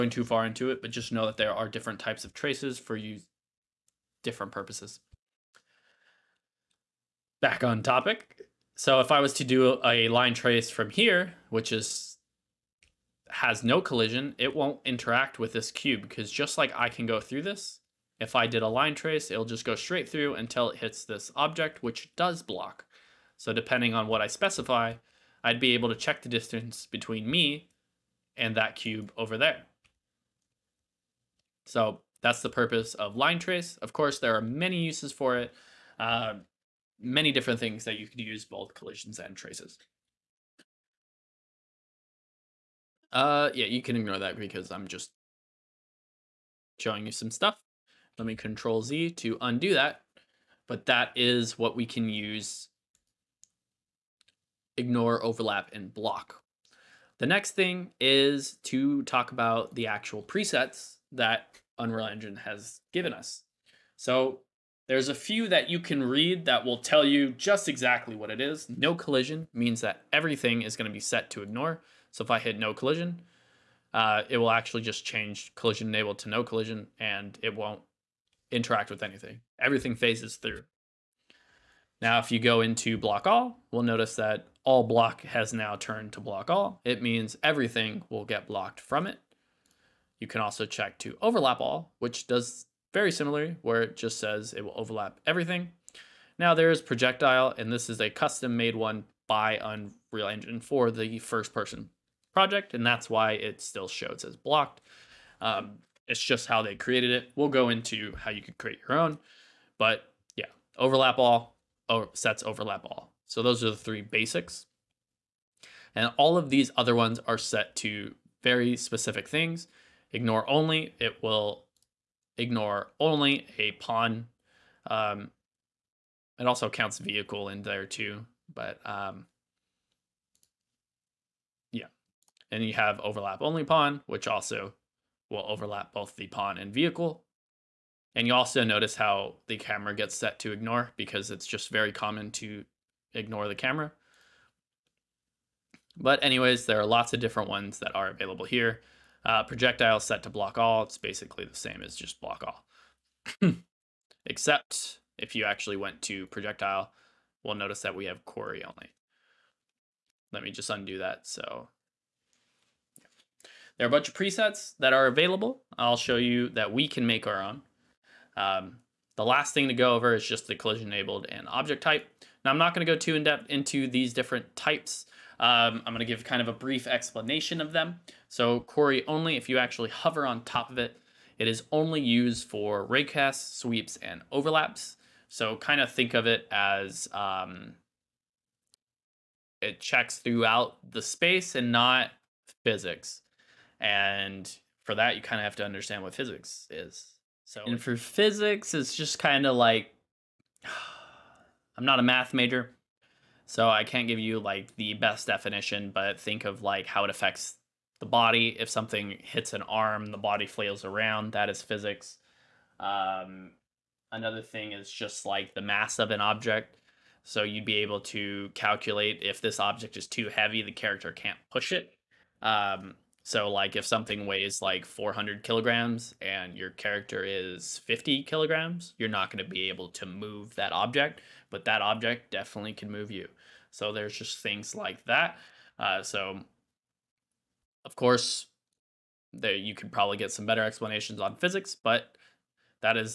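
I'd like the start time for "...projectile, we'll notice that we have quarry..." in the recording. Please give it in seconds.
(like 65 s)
156 s.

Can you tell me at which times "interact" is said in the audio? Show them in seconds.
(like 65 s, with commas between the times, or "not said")
14 s, 78 s.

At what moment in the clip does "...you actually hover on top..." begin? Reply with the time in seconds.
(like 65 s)
179 s.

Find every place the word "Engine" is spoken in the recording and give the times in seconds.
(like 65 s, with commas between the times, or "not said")
62 s, 100 s.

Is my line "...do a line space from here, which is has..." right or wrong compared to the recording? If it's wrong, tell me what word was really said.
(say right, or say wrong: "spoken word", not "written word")
wrong: "trace", not "space".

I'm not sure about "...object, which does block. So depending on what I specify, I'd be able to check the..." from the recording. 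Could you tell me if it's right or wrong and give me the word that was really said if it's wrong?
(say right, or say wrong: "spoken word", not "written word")
right.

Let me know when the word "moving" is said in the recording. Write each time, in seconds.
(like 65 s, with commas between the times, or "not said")
not said.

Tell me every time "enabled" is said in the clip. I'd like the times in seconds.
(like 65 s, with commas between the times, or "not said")
75 s, 170 s.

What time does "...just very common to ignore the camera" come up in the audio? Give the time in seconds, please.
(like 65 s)
141 s.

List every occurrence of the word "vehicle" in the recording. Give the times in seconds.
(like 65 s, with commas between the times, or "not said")
126 s, 136 s.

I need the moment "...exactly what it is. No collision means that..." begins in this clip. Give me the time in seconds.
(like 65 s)
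67 s.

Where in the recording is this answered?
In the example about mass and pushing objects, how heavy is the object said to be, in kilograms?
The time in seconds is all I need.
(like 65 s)
224 s.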